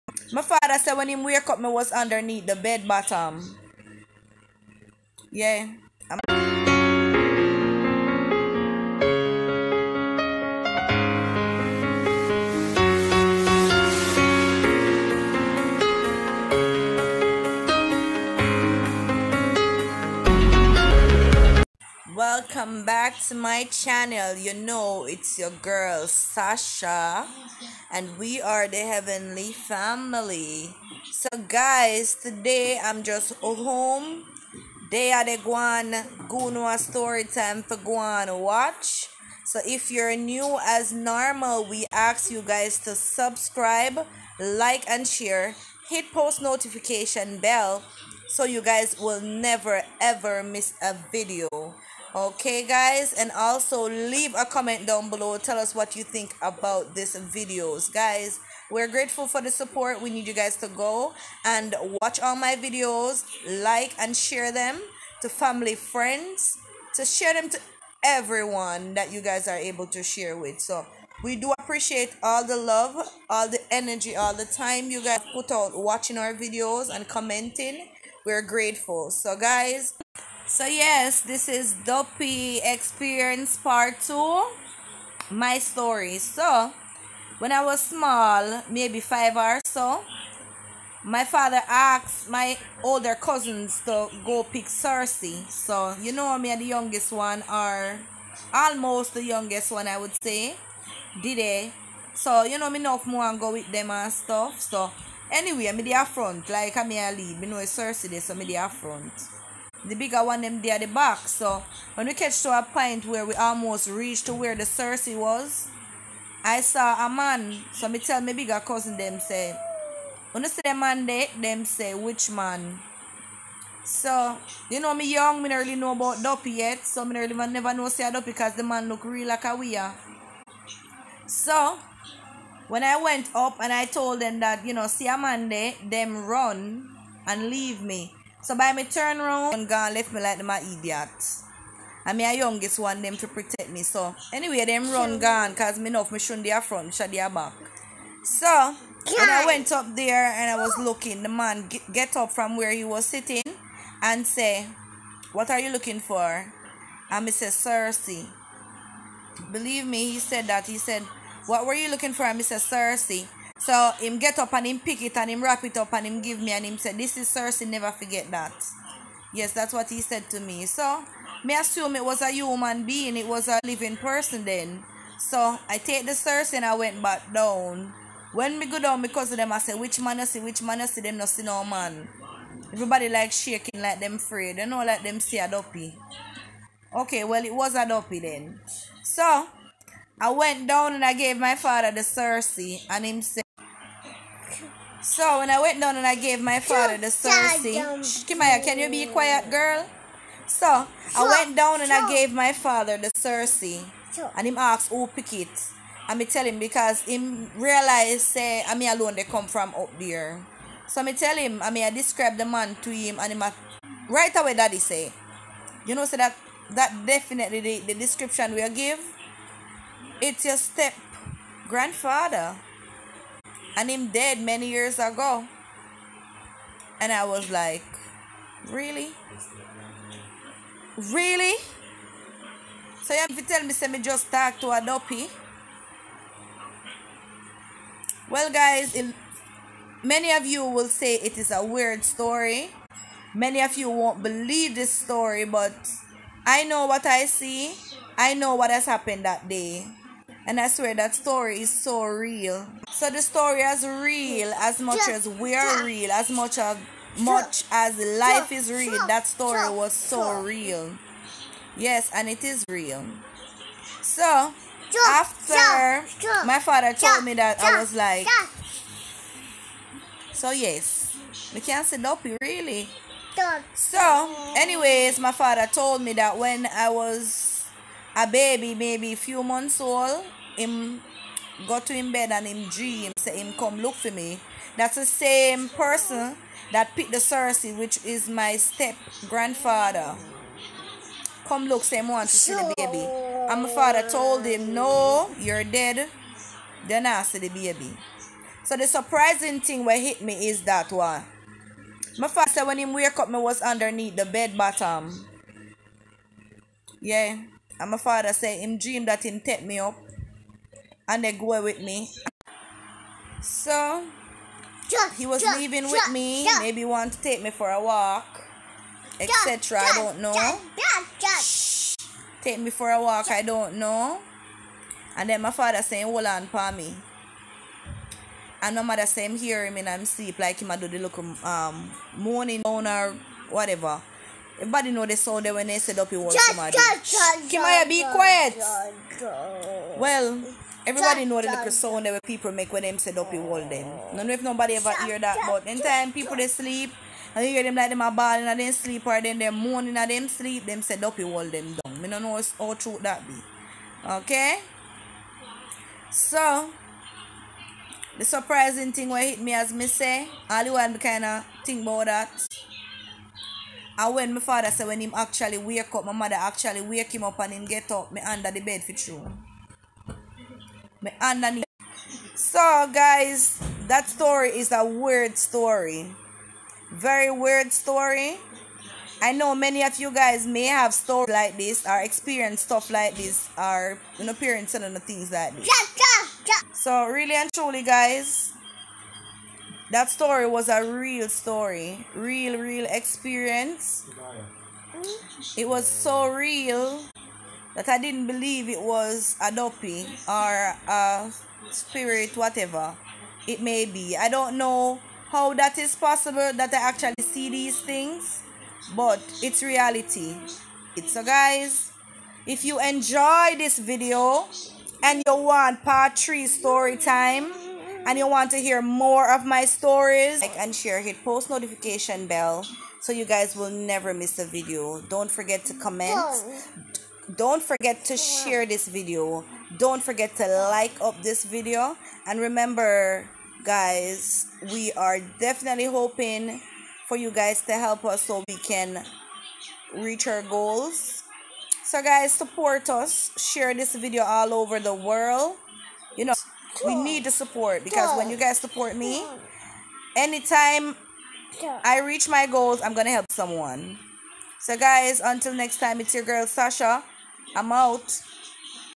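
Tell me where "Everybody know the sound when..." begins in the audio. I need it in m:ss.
5:34.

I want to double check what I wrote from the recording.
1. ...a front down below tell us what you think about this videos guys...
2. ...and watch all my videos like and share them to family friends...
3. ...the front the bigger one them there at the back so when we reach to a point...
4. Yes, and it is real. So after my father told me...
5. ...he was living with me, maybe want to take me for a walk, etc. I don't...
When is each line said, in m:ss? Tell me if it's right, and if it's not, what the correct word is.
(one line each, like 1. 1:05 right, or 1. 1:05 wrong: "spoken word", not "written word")
1. 0:54 wrong: "comment", not "front"
2. 1:01 right
3. 1:48 wrong: "catch", not "reach"
4. 4:21 right
5. 5:15 wrong: "leaving", not "living".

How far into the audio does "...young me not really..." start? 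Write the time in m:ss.
2:05.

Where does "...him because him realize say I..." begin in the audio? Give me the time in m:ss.
3:26.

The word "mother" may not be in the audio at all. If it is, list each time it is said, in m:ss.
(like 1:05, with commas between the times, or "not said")
5:28, 6:06.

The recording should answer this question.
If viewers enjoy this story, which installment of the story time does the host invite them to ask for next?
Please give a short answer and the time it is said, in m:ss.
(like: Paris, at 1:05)
Part 3, at 6:55.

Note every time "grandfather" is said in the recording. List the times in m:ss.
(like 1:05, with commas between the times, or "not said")
3:41, 4:49.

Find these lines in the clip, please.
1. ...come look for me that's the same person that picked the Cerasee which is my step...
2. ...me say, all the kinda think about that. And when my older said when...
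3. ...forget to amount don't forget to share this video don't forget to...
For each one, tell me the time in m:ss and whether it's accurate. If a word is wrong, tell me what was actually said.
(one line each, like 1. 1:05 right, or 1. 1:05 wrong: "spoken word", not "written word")
1. 4:43 right
2. 5:59 wrong: "father", not "older"
3. 7:05 wrong: "comment", not "amount".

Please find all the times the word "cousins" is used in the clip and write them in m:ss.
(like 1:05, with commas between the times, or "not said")
1:33, 1:58.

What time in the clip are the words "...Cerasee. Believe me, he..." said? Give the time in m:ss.
2:37.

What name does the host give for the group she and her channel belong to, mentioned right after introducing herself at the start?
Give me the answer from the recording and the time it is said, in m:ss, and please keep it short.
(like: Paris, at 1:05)
Heavenly Family, at 0:28.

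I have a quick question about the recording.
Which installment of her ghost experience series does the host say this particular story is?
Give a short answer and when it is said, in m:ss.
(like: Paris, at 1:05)
Part 2, at 1:23.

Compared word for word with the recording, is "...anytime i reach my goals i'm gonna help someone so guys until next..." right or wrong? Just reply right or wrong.
right.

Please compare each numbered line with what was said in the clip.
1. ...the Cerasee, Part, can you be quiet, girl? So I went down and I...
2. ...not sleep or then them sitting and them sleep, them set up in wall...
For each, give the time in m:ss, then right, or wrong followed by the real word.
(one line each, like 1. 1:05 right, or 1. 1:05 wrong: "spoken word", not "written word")
1. 3:16 wrong: "Kimaya", not "Part"
2. 5:48 wrong: "moaning", not "sitting".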